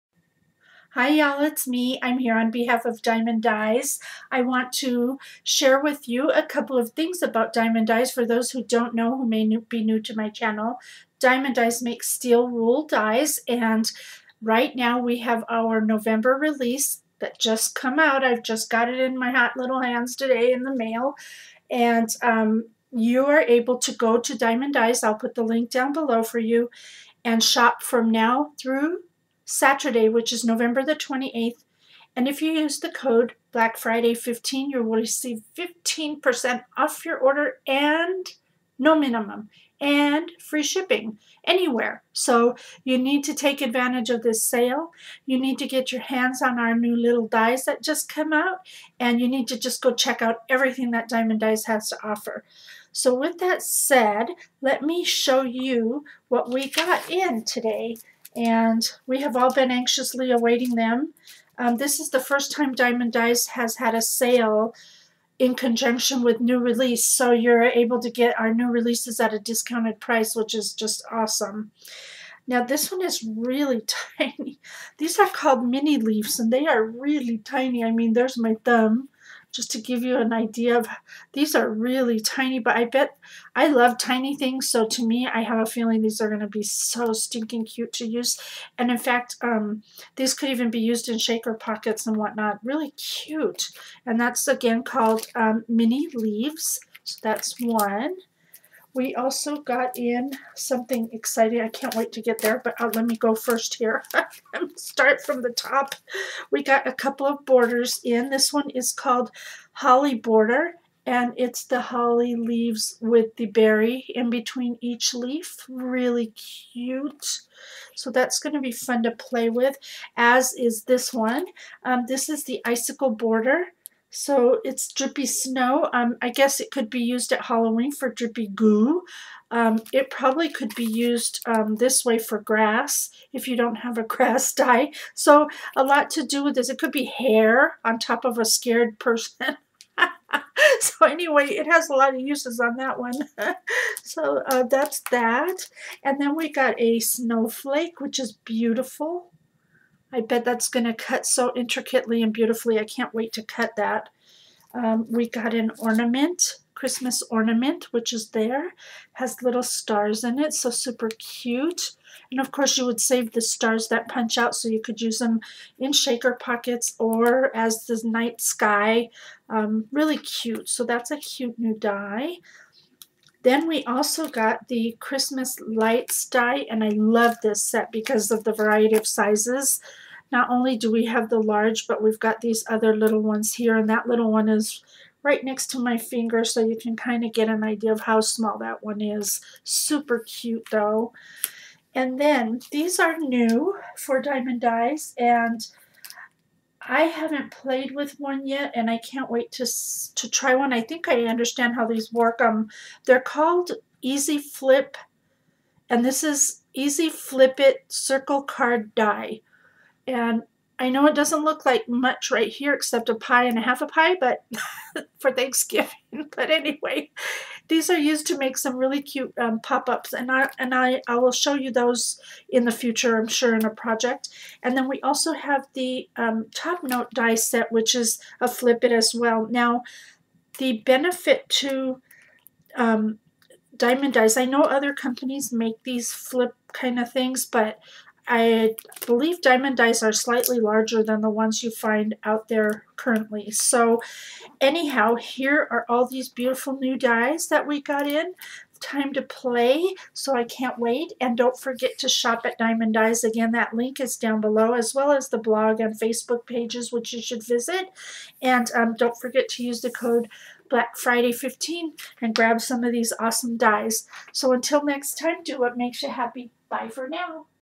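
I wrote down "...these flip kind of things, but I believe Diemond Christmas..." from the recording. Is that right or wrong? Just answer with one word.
wrong.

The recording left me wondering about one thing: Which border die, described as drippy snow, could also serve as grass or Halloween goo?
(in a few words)
Icicle Border.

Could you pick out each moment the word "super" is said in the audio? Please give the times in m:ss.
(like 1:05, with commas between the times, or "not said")
2:40, 3:09.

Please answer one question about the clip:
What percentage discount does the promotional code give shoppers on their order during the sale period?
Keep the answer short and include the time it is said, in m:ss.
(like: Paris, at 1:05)
15%, at 0:35.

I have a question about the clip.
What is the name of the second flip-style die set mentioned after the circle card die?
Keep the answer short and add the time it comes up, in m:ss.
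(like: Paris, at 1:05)
Top note die set, at 3:46.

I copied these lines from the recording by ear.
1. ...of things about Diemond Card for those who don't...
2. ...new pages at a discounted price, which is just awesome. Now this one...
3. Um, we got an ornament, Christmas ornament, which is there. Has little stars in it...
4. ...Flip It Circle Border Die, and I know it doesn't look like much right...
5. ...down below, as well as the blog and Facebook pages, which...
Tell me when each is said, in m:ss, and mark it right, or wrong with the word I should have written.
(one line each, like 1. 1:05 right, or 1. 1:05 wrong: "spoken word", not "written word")
1. 0:06 wrong: "Dies", not "Card"
2. 1:08 wrong: "releases", not "pages"
3. 2:34 right
4. 3:27 wrong: "Card", not "Border"
5. 4:14 right.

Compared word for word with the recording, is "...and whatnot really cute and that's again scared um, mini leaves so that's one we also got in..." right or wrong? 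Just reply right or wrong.
wrong.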